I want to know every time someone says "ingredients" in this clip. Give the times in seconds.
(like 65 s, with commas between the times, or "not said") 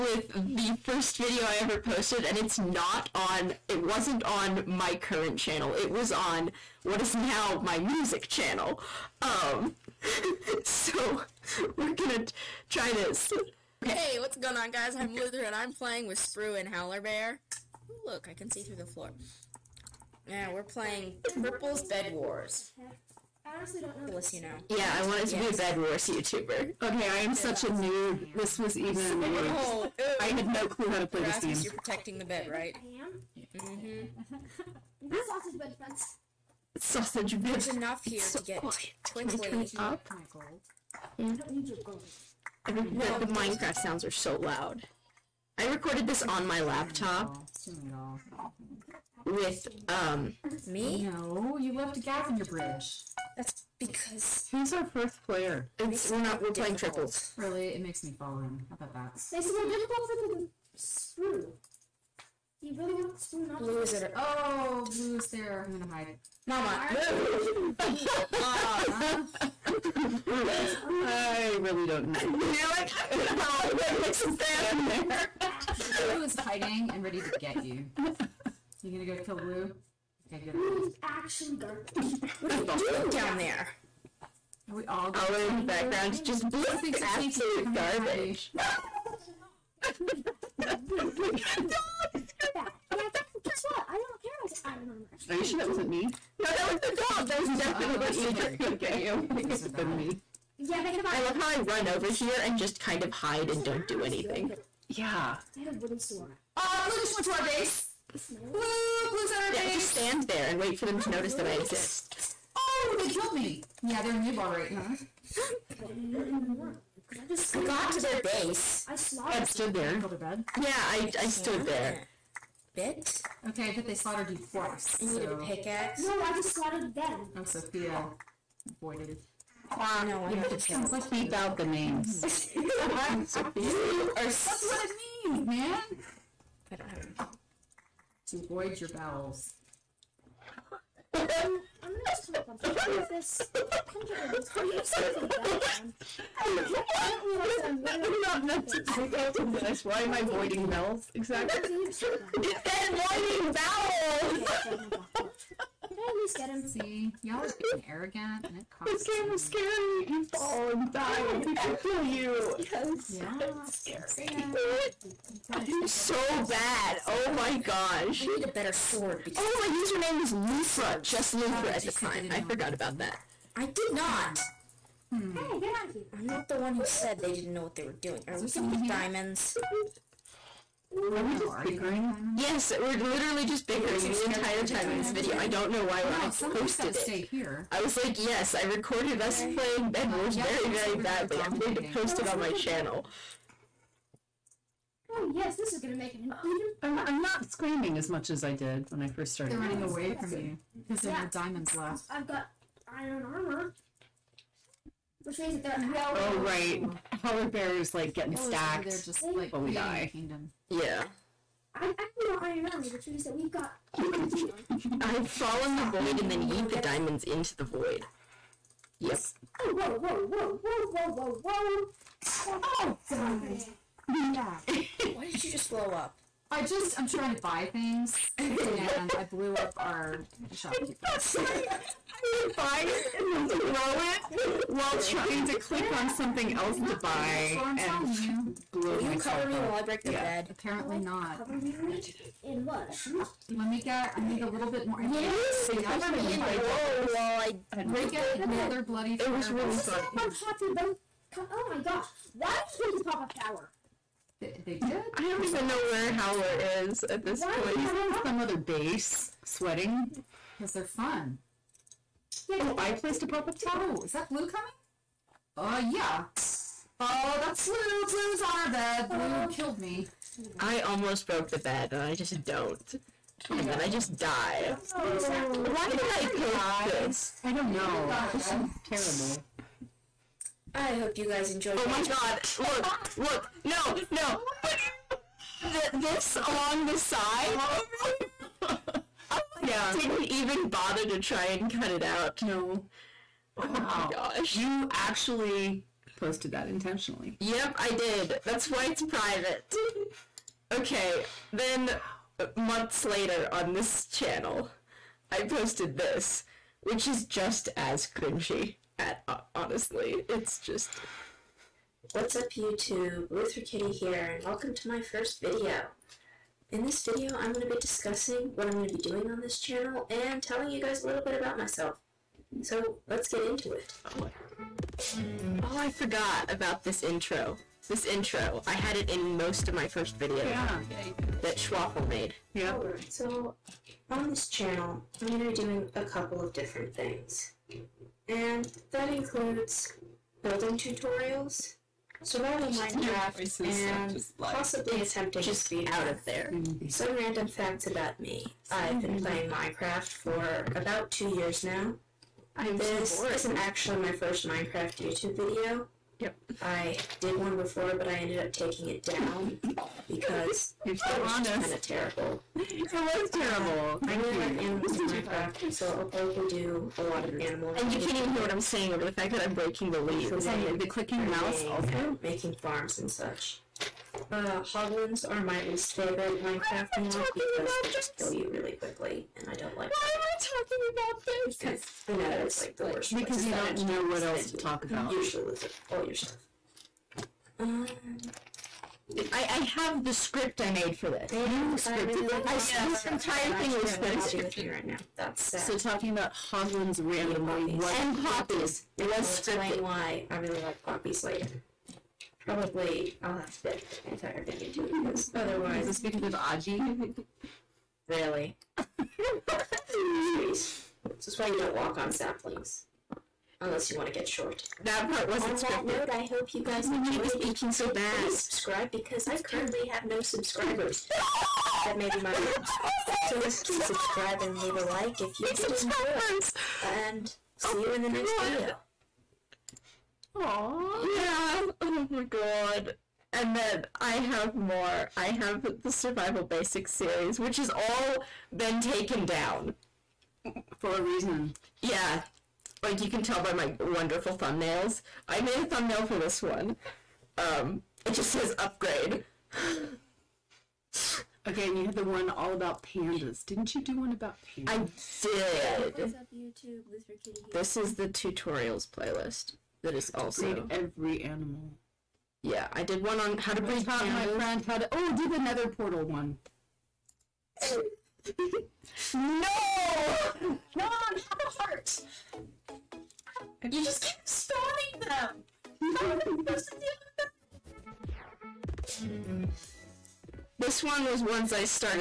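not said.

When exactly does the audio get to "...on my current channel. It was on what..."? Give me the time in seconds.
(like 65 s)
4 s.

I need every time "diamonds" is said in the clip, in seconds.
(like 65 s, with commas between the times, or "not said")
178 s, 201 s, 216 s.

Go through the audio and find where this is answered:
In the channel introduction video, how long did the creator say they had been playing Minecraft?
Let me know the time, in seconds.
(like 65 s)
350 s.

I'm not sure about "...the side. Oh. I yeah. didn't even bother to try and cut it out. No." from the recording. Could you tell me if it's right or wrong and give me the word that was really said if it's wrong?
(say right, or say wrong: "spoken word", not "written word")
right.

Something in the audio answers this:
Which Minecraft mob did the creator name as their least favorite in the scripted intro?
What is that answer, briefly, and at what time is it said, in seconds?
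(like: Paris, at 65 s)
Hoglins, at 374 s.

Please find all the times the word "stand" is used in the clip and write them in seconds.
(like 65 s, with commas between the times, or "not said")
74 s, 109 s.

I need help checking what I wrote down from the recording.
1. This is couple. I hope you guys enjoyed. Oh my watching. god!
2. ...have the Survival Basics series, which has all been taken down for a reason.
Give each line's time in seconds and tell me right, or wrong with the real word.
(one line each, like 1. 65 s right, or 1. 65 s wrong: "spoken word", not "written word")
1. 278 s wrong: "terrible", not "couple"
2. 435 s right.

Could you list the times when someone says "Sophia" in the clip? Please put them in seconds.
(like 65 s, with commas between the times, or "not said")
127 s, 133 s.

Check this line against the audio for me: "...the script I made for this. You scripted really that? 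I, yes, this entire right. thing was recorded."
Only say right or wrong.
wrong.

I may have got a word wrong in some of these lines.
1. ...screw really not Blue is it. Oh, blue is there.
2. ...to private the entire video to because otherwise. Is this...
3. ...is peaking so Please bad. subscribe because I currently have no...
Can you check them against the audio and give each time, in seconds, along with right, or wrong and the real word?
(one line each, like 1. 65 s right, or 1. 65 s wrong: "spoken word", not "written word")
1. 60 s right
2. 403 s wrong: "dedicate", not "private"
3. 417 s right.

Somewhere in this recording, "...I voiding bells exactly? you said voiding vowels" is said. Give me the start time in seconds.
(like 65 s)
150 s.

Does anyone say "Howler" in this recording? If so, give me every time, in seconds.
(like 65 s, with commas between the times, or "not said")
16 s, 207 s, 256 s.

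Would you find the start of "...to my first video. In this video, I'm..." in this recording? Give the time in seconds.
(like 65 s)
314 s.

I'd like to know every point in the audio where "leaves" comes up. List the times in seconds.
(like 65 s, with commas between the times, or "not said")
369 s, 424 s.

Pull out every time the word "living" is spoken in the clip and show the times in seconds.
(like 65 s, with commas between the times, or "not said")
not said.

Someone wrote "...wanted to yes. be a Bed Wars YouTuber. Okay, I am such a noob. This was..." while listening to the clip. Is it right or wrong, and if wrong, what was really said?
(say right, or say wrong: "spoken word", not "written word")
right.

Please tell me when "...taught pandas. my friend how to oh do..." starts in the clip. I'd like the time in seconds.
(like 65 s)
463 s.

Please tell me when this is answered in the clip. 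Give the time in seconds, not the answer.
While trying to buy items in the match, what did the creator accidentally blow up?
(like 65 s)
229 s.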